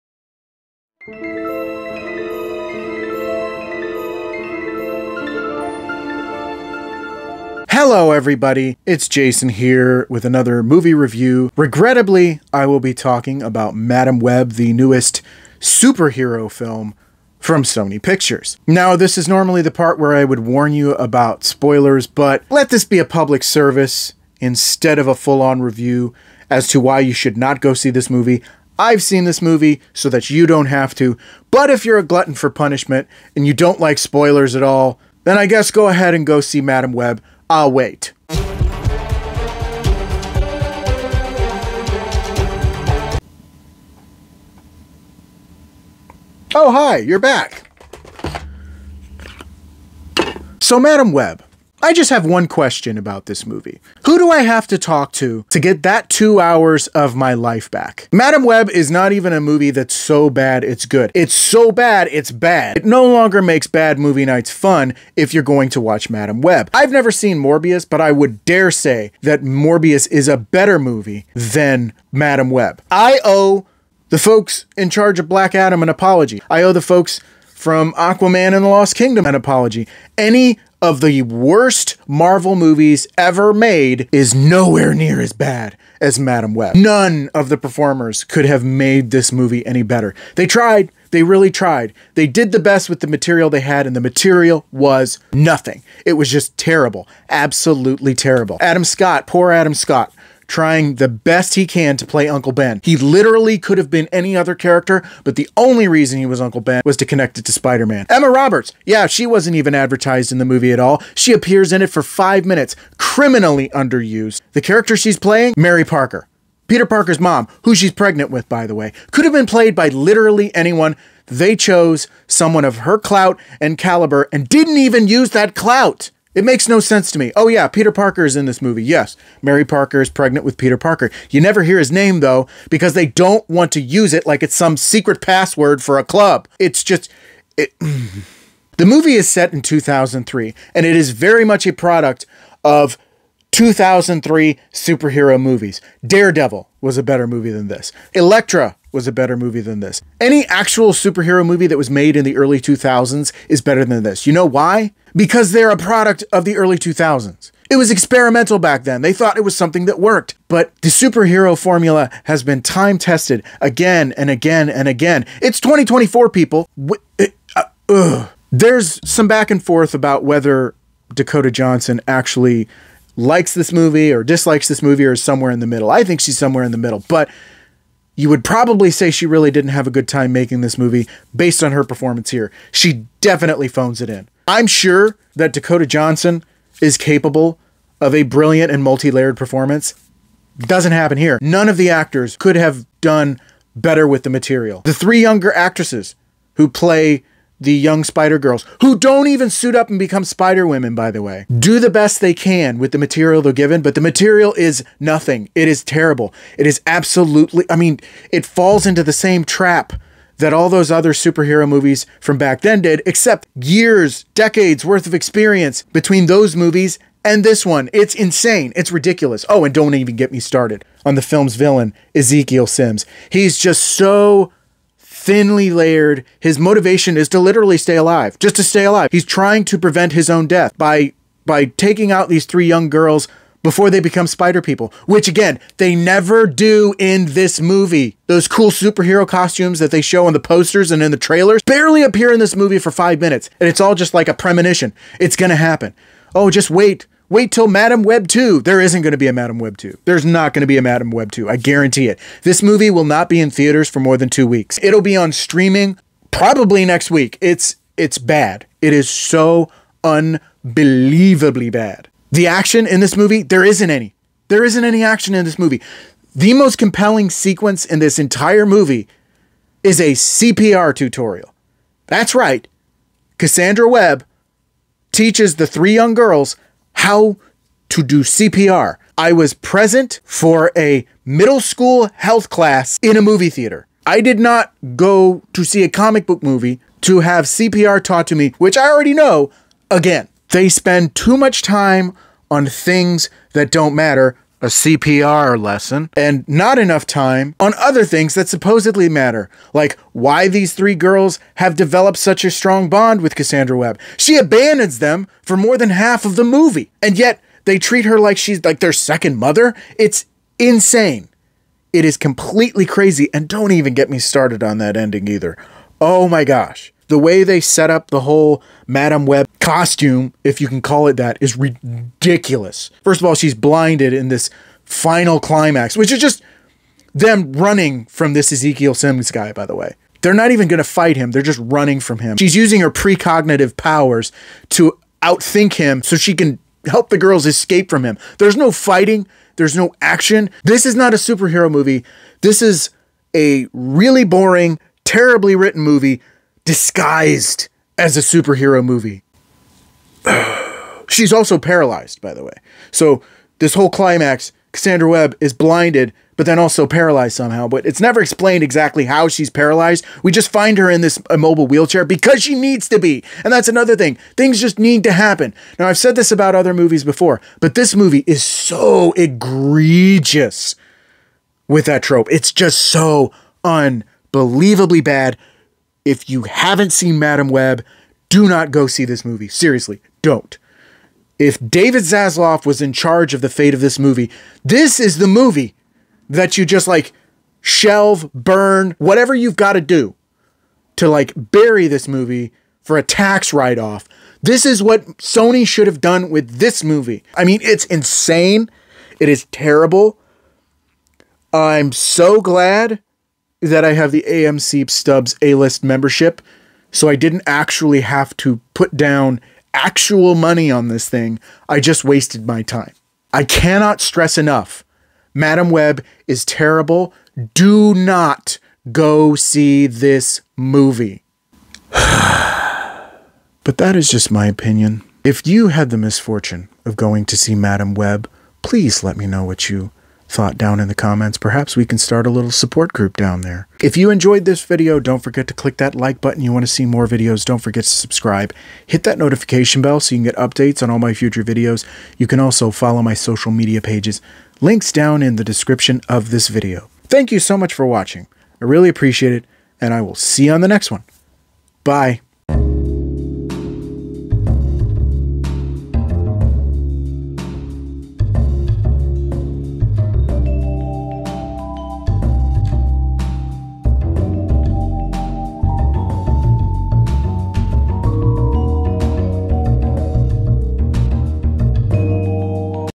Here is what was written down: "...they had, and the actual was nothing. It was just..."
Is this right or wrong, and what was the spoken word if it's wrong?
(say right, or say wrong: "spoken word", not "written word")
wrong: "material", not "actual".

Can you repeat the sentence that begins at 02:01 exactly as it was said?
They chose someone of her clout and caliber and didn't even use that clout.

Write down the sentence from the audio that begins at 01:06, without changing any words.
I've never seen Morbius, but I would dare say that Morbius is a better movie than Madame Web.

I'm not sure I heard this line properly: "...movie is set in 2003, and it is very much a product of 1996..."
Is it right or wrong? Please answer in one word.
wrong.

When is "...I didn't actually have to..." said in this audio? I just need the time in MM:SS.
06:47.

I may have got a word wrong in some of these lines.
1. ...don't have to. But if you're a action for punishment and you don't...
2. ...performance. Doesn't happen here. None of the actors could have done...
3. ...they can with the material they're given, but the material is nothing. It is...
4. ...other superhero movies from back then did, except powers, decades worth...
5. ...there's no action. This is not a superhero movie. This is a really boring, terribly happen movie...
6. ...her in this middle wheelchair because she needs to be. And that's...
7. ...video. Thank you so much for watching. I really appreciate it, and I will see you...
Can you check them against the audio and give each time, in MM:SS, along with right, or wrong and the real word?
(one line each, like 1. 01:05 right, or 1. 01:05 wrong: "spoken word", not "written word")
1. 00:30 wrong: "glutton", not "action"
2. 03:09 right
3. 03:22 right
4. 03:30 wrong: "years", not "powers"
5. 05:39 wrong: "written", not "happen"
6. 06:00 wrong: "immobile", not "middle"
7. 07:26 right.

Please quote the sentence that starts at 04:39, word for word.
I was present for a middle school health class in a movie theater.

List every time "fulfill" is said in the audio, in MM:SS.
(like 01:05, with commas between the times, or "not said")
not said.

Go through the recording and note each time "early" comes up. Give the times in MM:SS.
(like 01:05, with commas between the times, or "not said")
02:32, 02:36.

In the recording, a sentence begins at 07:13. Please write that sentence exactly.
If you enjoyed this video, don't forget to click that like button.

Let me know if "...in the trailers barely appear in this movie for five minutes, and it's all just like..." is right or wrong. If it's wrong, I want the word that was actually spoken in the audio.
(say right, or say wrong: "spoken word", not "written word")
right.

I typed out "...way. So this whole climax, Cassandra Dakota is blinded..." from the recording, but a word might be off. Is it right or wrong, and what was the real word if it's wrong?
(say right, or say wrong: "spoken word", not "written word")
wrong: "Webb", not "Dakota".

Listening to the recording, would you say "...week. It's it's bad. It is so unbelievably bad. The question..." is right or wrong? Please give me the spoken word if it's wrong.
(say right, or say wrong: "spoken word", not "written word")
wrong: "action", not "question".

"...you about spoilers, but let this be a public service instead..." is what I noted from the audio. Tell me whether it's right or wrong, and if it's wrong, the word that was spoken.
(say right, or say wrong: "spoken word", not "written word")
right.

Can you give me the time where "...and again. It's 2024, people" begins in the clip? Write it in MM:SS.
02:44.